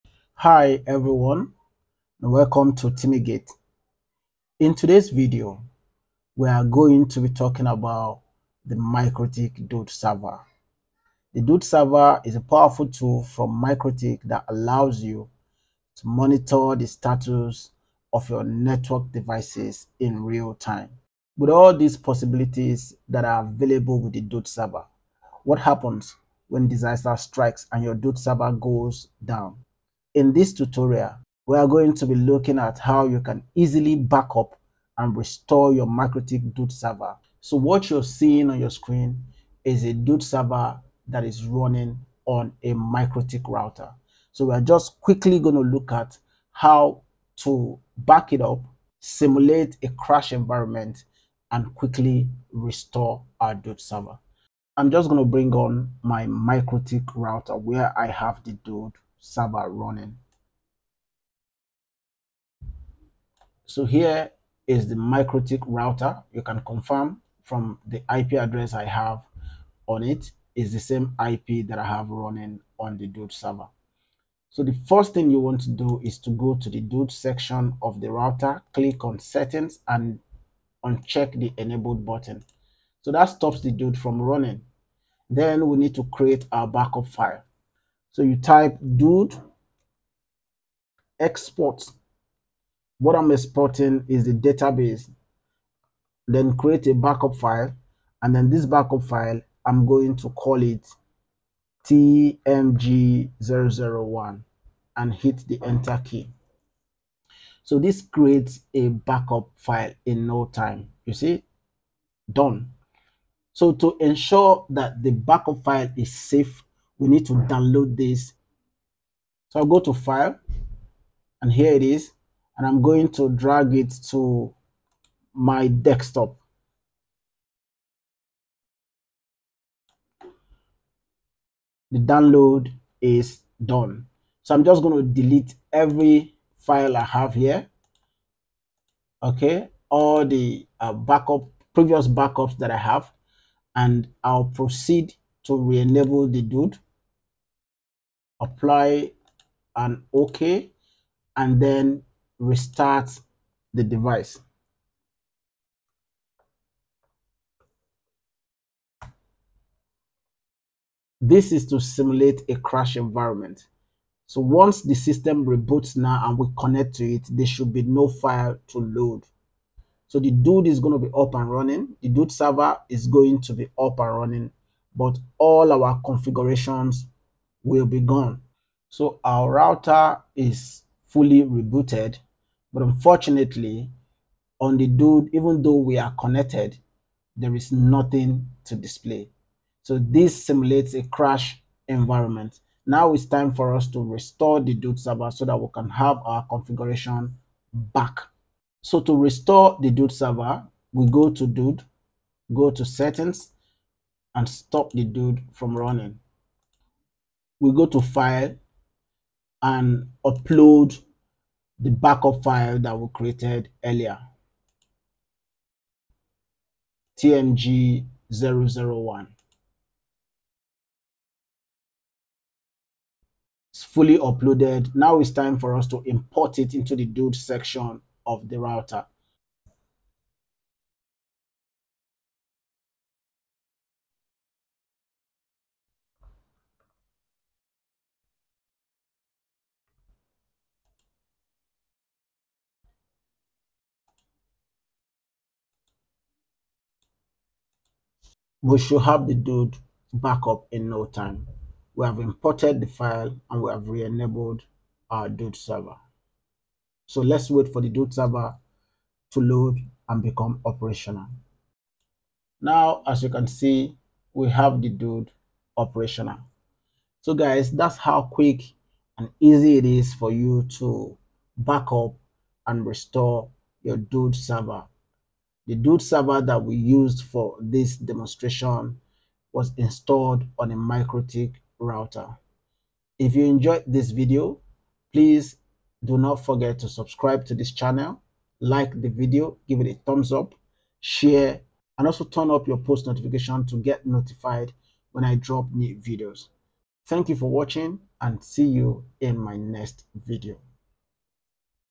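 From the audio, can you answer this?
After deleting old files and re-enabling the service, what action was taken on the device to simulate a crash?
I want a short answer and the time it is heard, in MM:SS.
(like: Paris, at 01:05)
restart the device, at 02:32.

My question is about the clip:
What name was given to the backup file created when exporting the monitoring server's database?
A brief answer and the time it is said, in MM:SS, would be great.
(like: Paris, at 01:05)
TMG001, at 01:41.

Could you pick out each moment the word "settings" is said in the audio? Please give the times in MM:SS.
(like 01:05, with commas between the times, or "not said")
01:19, 03:22.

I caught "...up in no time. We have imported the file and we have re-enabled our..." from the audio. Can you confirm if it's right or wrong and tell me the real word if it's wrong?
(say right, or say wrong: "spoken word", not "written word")
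right.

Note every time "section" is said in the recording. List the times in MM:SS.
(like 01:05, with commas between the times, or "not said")
01:17, 03:47.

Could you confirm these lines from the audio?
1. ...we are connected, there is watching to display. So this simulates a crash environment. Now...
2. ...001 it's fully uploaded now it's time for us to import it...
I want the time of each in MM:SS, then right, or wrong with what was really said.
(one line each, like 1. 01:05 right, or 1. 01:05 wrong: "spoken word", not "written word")
1. 03:05 wrong: "nothing", not "watching"
2. 03:38 right.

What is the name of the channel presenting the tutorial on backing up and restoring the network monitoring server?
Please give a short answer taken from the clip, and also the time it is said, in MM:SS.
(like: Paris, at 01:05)
TimiGate, at 00:02.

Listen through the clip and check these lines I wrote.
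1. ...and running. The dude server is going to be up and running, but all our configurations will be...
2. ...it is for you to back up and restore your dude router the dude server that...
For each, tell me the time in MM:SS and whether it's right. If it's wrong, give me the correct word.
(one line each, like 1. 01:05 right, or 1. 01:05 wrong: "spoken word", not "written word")
1. 02:51 right
2. 04:29 wrong: "server", not "router".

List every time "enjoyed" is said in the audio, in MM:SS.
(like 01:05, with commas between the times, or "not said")
04:43.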